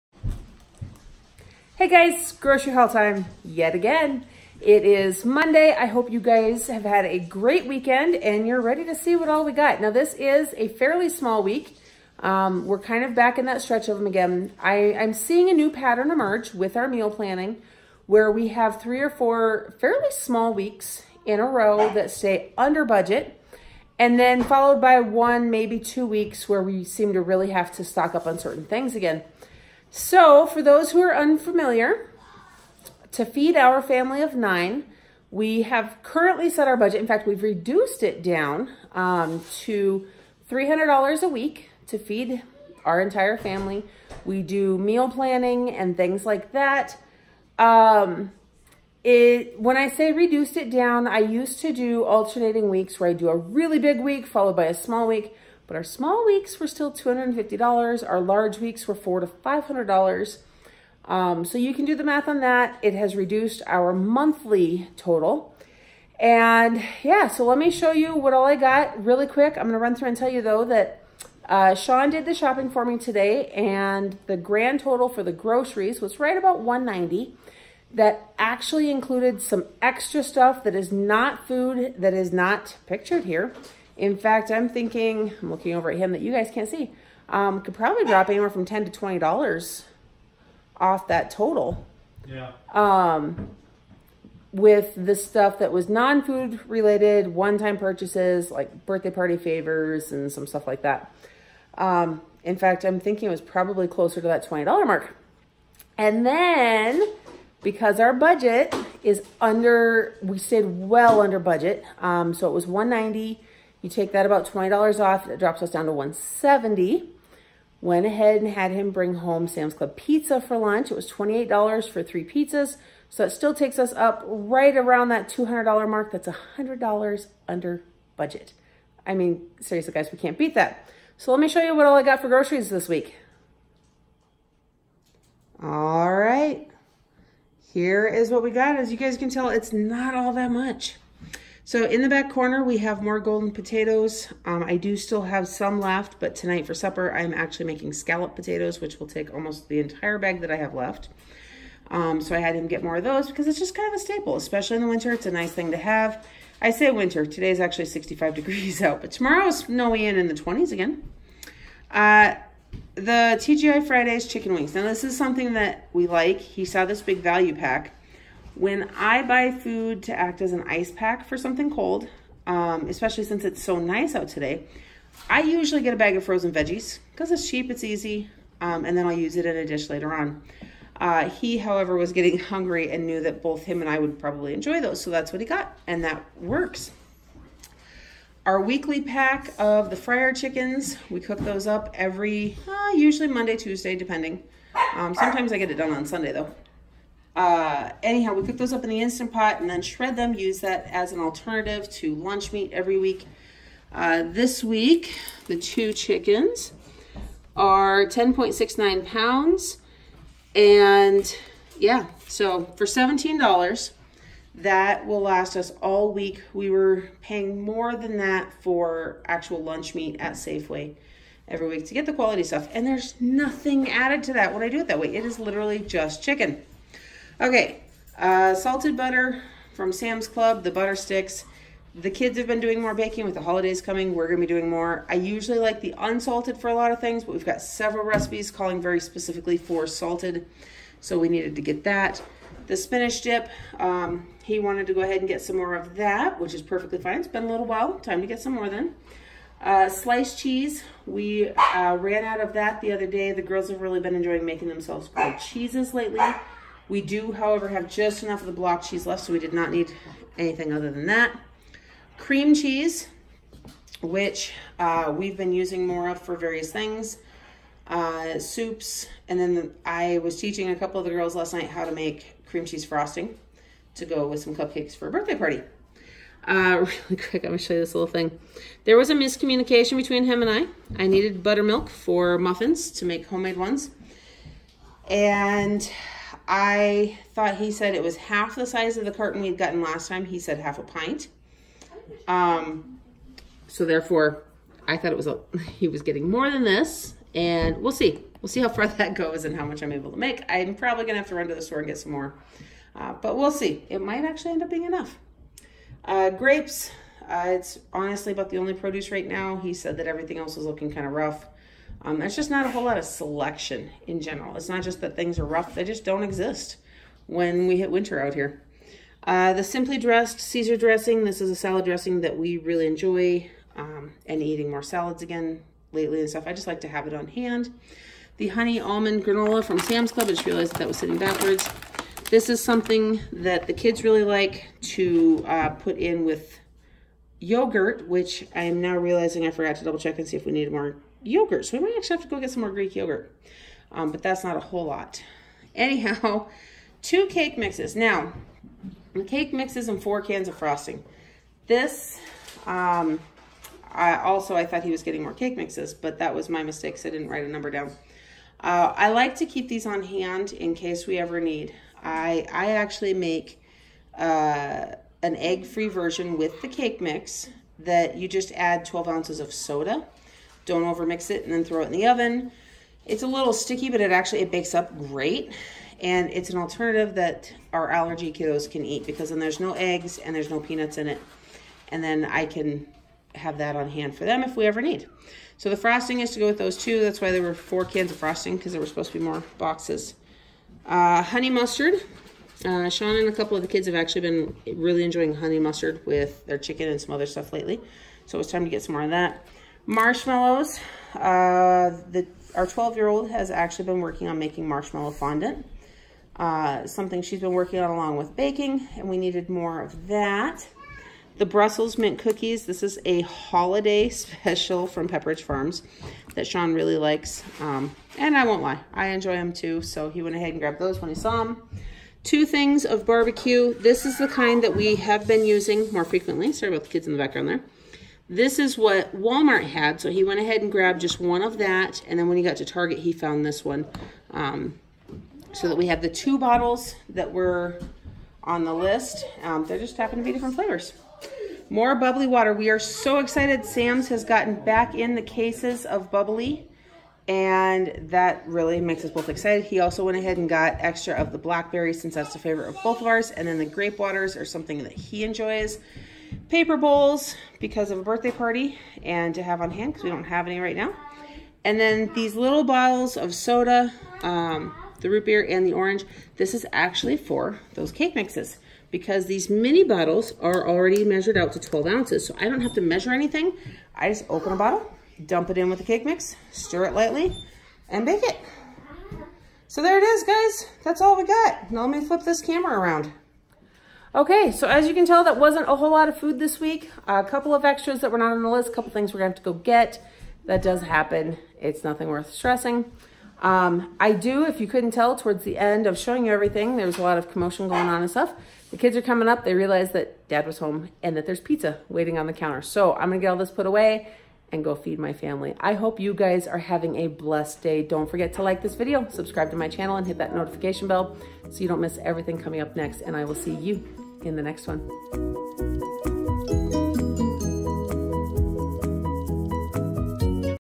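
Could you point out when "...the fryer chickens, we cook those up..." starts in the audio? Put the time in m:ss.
3:09.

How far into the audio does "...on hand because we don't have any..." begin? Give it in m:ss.
7:39.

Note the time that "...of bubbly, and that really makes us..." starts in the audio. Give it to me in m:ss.
7:25.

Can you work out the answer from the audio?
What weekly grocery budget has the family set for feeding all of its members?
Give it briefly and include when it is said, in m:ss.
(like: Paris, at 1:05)
$300, at 0:40.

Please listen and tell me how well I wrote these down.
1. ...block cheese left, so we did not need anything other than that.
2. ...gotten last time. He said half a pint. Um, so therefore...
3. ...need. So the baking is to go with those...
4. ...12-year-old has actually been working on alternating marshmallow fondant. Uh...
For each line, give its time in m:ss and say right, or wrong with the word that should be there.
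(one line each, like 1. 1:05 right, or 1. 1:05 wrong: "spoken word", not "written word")
1. 4:18 right
2. 4:49 right
3. 6:24 wrong: "frosting", not "baking"
4. 6:42 wrong: "making", not "alternating".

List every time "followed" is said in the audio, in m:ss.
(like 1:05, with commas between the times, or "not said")
0:24, 0:54.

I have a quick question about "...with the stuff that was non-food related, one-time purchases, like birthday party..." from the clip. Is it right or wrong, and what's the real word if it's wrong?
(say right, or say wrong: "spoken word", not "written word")
right.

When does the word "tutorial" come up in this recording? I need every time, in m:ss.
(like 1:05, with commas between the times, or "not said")
not said.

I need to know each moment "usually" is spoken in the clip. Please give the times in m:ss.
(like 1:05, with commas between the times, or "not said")
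2:55, 3:12, 3:55.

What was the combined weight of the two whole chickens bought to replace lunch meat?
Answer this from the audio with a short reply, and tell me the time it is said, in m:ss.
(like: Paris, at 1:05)
10.69 pounds, at 3:28.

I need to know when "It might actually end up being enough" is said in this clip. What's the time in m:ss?
5:03.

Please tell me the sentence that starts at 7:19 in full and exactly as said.
Um, they just happen to be different flavors.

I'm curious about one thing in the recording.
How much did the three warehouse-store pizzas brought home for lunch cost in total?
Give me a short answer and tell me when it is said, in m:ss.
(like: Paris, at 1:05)
$28, at 2:01.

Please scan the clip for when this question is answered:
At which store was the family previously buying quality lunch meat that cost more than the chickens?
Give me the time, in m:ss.
3:40.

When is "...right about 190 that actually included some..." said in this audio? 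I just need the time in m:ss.
1:16.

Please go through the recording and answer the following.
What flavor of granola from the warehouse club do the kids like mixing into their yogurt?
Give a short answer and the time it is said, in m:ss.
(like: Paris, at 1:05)
Honey Almond, at 5:28.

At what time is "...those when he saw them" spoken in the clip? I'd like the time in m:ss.
7:00.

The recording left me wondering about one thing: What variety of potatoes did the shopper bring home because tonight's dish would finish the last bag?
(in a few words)
Golden potatoes.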